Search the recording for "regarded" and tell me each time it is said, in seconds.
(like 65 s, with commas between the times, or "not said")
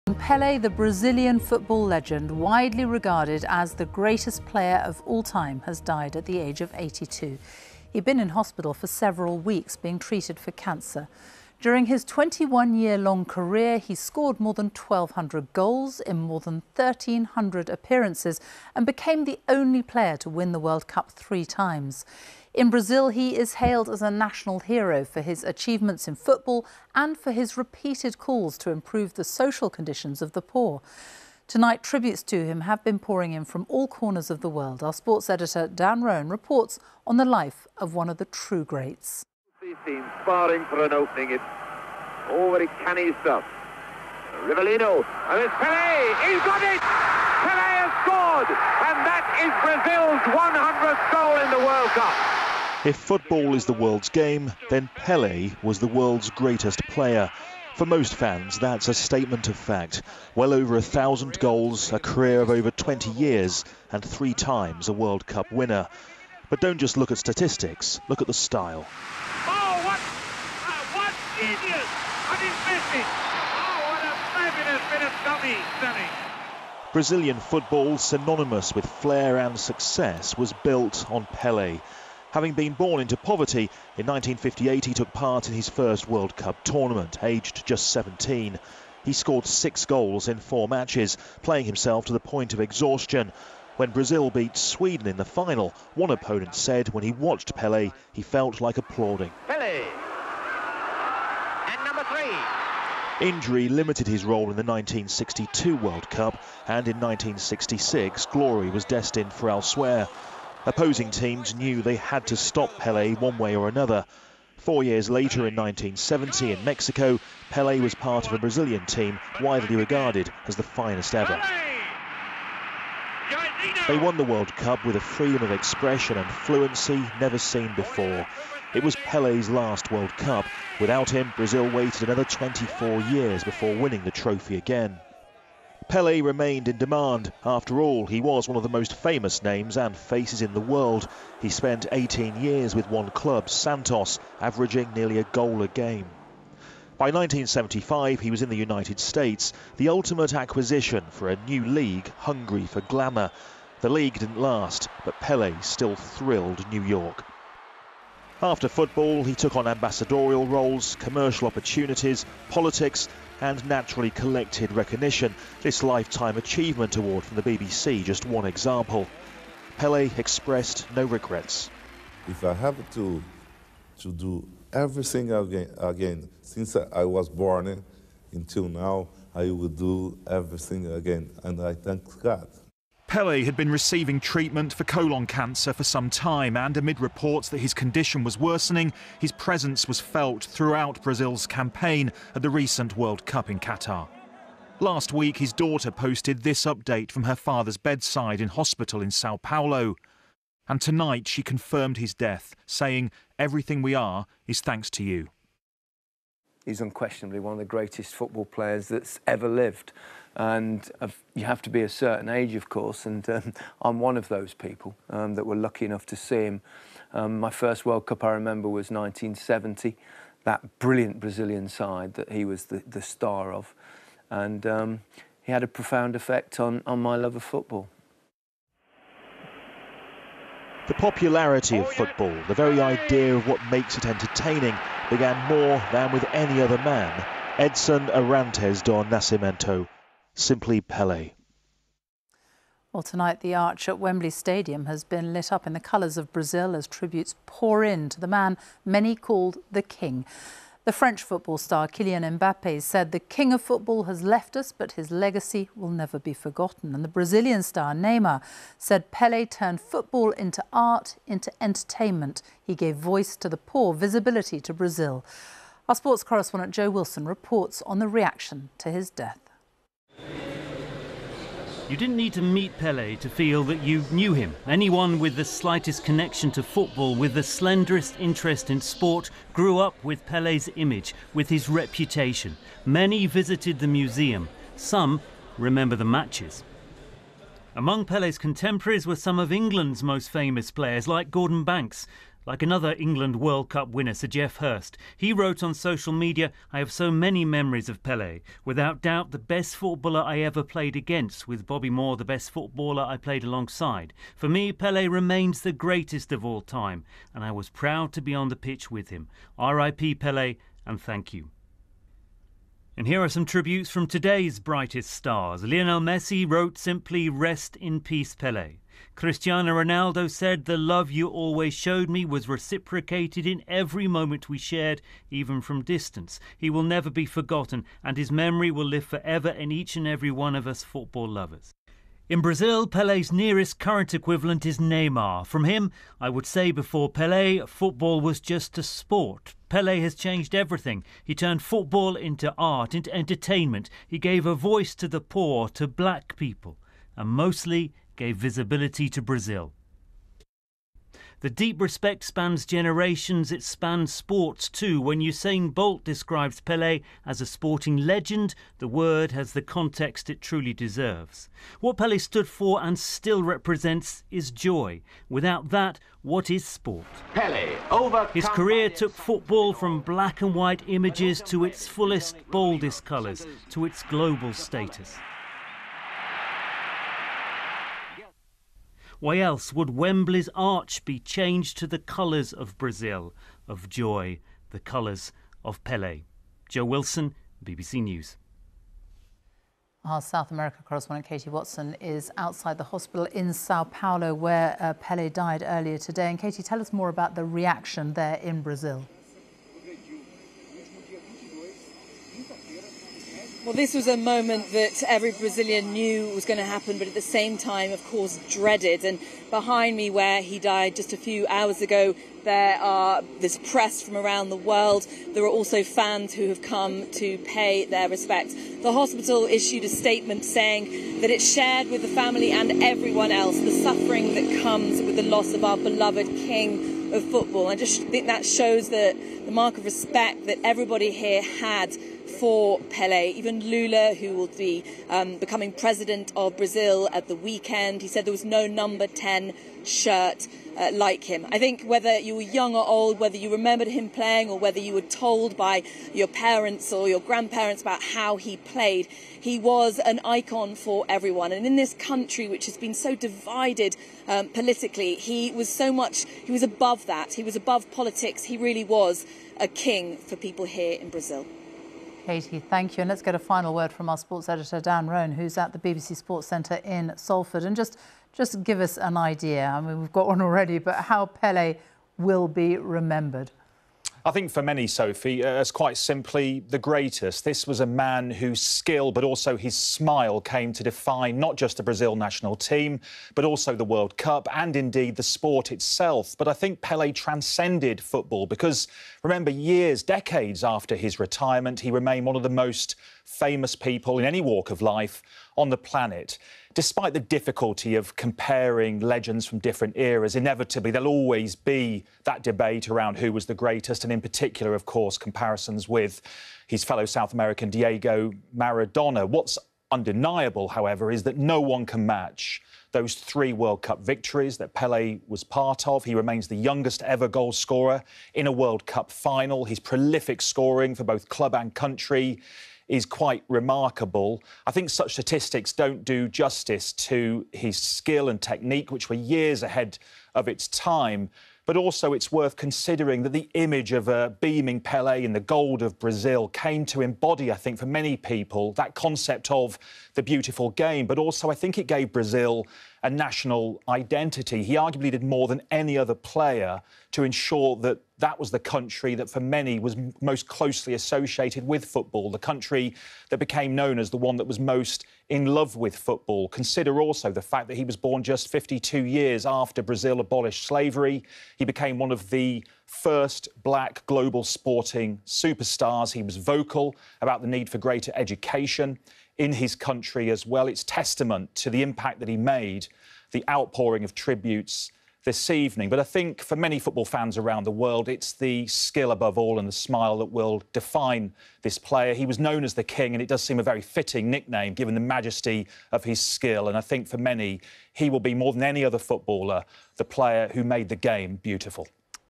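2 s, 119 s.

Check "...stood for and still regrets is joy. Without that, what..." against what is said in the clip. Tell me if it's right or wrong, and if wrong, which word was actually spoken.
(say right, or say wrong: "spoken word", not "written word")
wrong: "represents", not "regrets".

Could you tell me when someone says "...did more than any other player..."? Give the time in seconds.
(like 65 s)
545 s.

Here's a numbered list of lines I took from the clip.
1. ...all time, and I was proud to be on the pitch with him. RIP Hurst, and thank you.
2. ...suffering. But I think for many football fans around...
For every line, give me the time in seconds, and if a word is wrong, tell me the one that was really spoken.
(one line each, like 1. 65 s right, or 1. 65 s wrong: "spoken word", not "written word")
1. 306 s wrong: "Pele", not "Hurst"
2. 575 s wrong: "evening", not "suffering".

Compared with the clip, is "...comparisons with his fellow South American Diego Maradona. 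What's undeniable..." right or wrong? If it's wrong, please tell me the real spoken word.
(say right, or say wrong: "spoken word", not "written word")
right.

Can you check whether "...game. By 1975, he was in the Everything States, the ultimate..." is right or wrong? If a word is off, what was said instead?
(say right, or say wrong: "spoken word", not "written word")
wrong: "United", not "Everything".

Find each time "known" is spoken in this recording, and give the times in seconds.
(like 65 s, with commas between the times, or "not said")
553 s, 582 s.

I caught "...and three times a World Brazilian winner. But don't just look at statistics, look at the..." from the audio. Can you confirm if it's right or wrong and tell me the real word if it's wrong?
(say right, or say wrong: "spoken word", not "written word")
wrong: "Cup", not "Brazilian".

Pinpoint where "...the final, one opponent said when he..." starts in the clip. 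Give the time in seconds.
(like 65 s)
95 s.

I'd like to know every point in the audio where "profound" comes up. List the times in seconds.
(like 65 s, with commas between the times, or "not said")
225 s.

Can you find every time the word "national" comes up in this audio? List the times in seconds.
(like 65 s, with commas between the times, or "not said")
24 s, 482 s, 543 s.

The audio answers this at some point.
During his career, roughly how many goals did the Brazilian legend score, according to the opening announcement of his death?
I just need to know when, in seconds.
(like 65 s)
14 s.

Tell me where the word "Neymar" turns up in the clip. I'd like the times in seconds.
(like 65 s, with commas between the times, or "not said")
257 s, 334 s.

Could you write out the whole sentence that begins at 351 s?
The deep respect spans generations, it spans sports too.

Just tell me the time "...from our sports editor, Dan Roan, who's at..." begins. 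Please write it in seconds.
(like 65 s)
463 s.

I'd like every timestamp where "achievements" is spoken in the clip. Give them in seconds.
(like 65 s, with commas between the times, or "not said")
25 s, 166 s.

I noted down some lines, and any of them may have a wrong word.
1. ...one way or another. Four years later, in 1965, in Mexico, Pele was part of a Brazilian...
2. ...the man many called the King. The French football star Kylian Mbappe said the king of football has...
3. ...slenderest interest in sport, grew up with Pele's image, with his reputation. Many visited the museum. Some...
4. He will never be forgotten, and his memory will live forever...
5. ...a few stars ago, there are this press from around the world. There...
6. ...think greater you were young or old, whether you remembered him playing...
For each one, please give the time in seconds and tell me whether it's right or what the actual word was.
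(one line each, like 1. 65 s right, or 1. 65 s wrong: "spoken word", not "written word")
1. 113 s wrong: "1970", not "1965"
2. 248 s right
3. 277 s right
4. 326 s right
5. 411 s wrong: "hours", not "stars"
6. 441 s wrong: "whether", not "greater".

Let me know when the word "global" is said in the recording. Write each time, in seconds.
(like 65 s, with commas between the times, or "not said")
374 s, 564 s.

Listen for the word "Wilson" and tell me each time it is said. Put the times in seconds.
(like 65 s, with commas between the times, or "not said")
266 s, 386 s.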